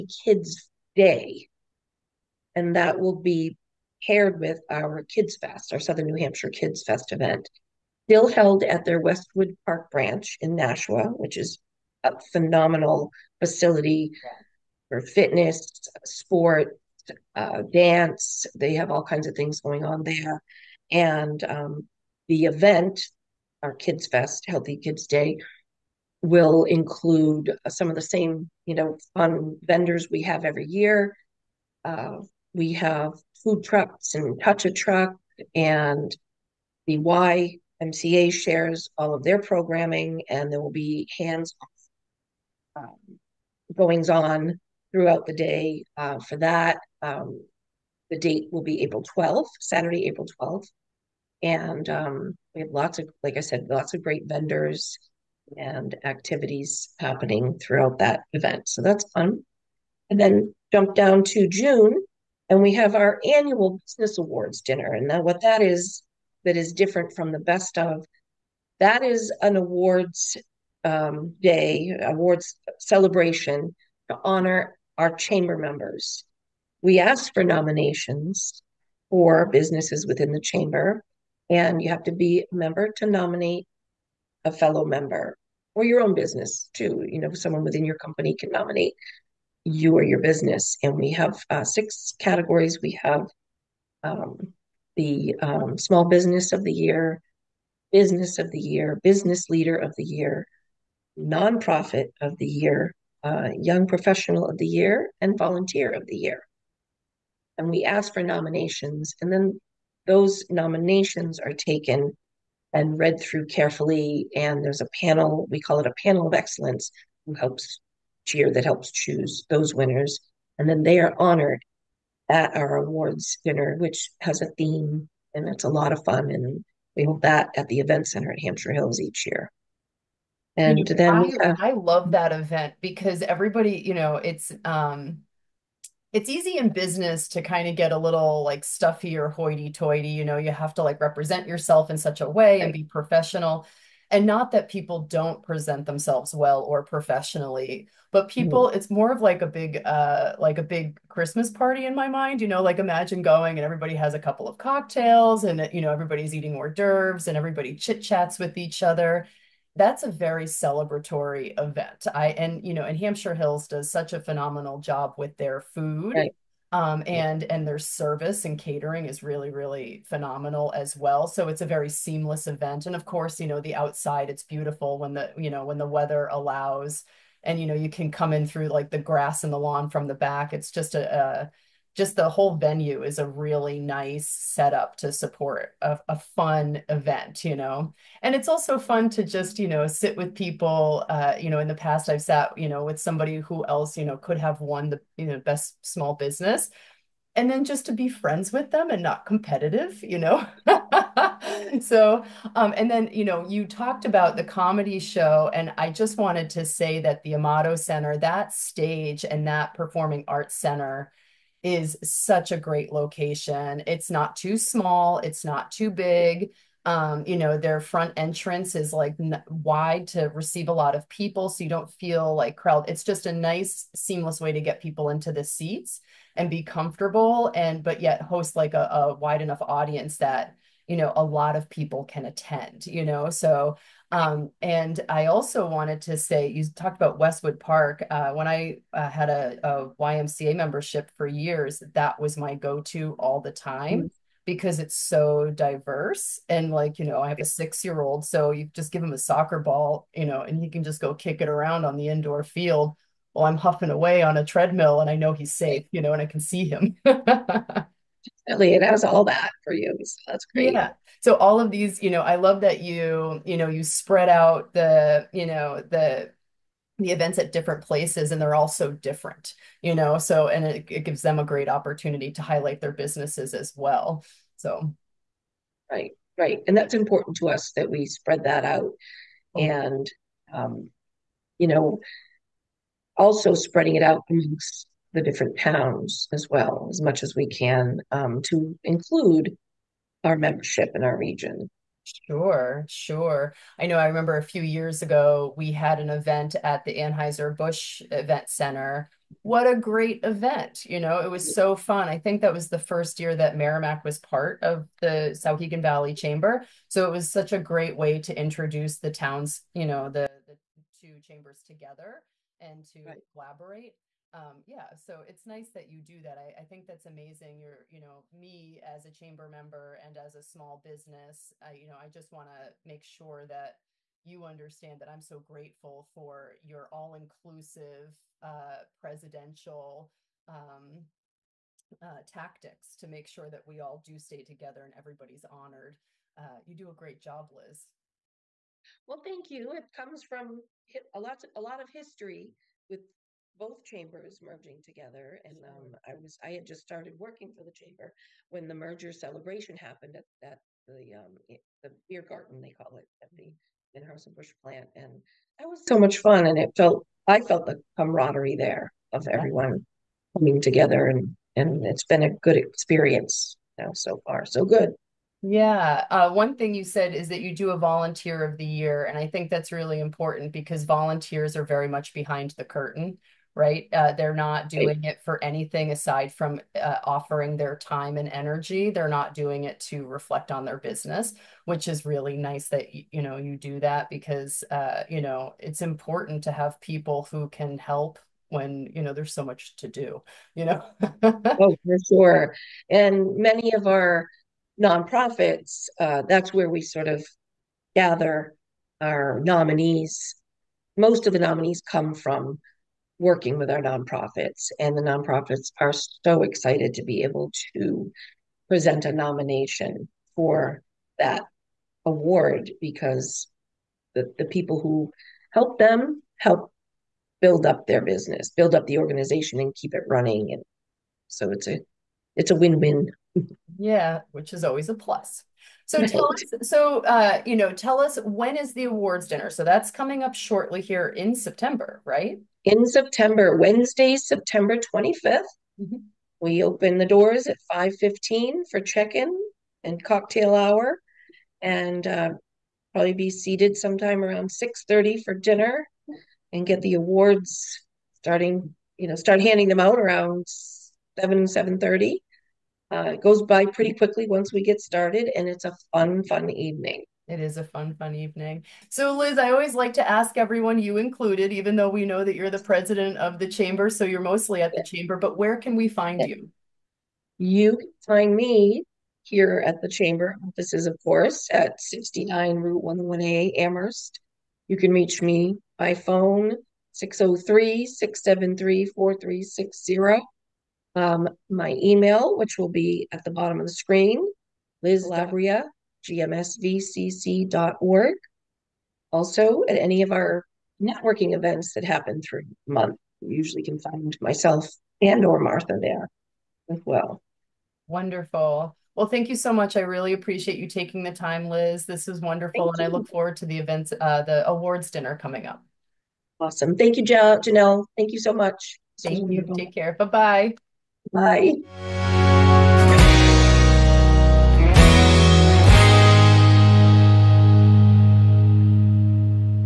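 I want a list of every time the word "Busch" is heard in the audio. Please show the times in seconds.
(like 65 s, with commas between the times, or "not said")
296 s, 353 s.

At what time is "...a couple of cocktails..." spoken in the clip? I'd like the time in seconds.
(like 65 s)
154 s.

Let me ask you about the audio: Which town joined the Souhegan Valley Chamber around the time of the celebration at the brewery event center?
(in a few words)
Merrimack.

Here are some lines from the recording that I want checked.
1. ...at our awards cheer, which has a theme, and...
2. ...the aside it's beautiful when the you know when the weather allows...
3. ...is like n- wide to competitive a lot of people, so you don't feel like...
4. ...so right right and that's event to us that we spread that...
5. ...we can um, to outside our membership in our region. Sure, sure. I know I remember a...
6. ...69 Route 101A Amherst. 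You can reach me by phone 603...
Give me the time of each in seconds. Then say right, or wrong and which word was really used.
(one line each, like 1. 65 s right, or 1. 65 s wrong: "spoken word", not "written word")
1. 122 s wrong: "dinner", not "cheer"
2. 173 s wrong: "outside", not "aside"
3. 218 s wrong: "receive", not "competitive"
4. 274 s wrong: "important", not "event"
5. 287 s wrong: "include", not "outside"
6. 471 s right.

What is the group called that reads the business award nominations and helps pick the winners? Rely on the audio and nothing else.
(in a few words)
panel of excellence.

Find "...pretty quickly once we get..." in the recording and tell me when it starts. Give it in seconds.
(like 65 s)
453 s.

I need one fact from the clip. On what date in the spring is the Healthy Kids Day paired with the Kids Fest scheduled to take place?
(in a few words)
Saturday, April 12th.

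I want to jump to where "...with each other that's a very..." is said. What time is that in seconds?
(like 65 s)
158 s.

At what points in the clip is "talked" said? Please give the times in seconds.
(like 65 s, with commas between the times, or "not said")
203 s, 236 s.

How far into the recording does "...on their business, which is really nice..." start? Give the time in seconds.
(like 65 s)
380 s.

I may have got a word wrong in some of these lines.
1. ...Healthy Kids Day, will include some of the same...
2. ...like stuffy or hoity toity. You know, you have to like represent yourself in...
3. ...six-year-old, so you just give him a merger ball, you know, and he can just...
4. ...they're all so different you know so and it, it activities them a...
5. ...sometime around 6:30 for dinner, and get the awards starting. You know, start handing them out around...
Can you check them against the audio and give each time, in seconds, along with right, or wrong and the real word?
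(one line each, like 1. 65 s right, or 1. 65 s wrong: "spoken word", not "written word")
1. 24 s right
2. 138 s right
3. 247 s wrong: "soccer", not "merger"
4. 268 s wrong: "gives", not "activities"
5. 443 s right.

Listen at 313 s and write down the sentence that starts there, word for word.
collaborate um, yeah, so it's nice that you do that.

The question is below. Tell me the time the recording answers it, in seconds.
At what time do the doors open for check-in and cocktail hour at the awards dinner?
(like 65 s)
437 s.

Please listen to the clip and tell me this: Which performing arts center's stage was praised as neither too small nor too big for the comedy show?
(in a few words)
Amato Center.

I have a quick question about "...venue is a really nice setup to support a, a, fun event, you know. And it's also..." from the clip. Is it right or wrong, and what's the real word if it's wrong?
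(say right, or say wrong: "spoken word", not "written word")
right.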